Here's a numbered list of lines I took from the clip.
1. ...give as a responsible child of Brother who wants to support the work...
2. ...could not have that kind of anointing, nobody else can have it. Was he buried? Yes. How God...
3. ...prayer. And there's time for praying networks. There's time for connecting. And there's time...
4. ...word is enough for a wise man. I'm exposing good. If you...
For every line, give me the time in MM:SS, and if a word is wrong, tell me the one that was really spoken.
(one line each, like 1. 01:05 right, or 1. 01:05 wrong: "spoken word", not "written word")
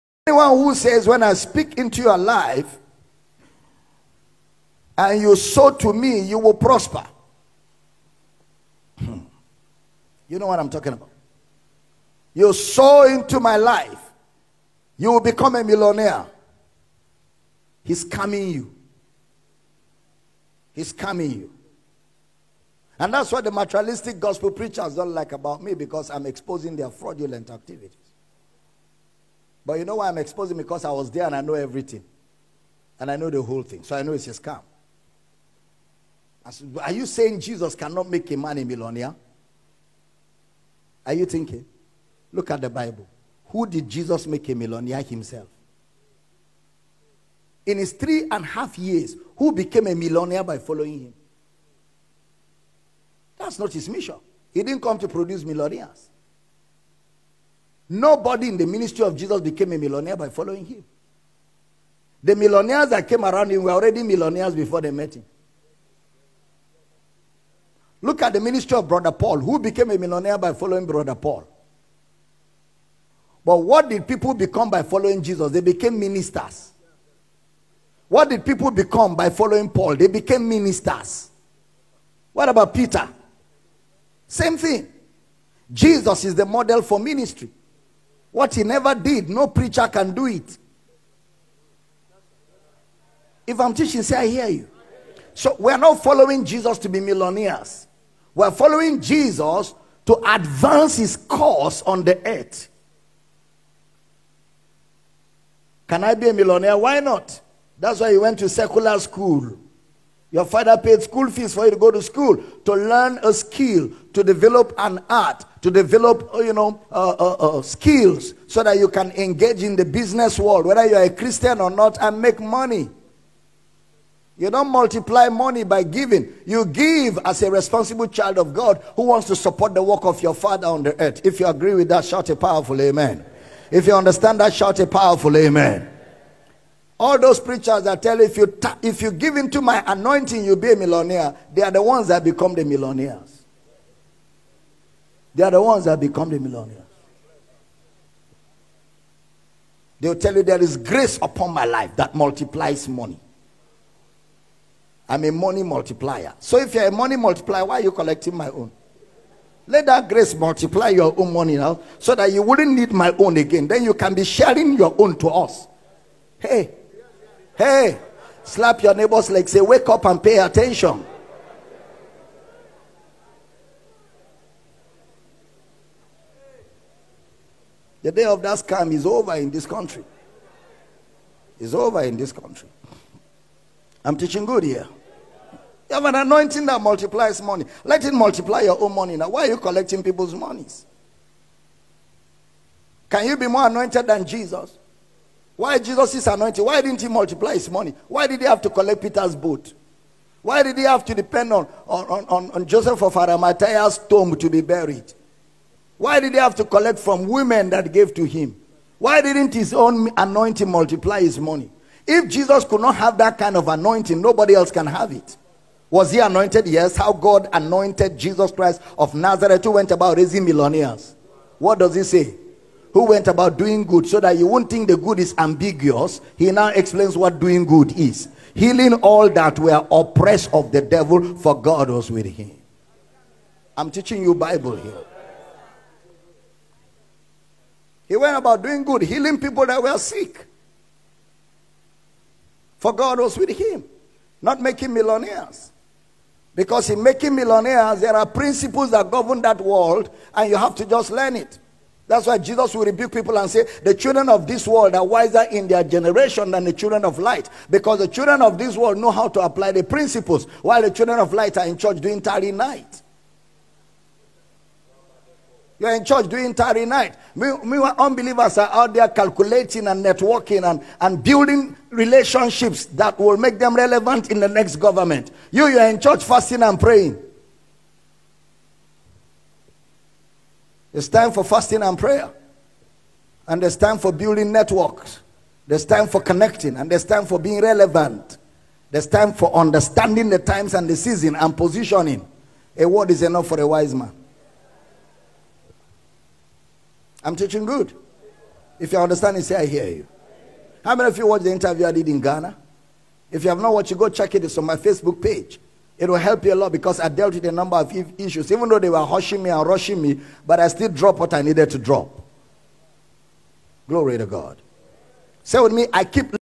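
1. 02:06 wrong: "God", not "Brother"
2. 03:32 wrong: "anointed", not "buried"
3. 04:41 wrong: "building", not "praying"
4. 04:52 wrong: "teaching", not "exposing".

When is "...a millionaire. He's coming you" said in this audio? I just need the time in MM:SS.
00:15.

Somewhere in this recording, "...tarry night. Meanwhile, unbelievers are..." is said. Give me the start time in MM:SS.
04:26.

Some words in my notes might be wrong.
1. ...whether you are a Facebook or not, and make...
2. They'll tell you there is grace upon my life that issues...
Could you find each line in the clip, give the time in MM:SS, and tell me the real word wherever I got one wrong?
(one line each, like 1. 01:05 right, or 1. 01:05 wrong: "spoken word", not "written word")
1. 02:00 wrong: "Christian", not "Facebook"
2. 02:29 wrong: "multiplies", not "issues".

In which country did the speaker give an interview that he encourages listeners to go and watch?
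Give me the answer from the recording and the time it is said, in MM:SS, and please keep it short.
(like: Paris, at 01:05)
Ghana, at 05:02.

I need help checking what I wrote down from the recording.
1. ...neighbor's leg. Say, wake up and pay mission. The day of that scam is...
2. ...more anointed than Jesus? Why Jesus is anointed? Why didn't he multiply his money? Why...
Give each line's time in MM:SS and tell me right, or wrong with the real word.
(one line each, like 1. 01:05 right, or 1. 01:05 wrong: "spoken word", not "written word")
1. 02:48 wrong: "attention", not "mission"
2. 03:13 right.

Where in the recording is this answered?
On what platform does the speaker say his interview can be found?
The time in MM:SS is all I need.
05:04.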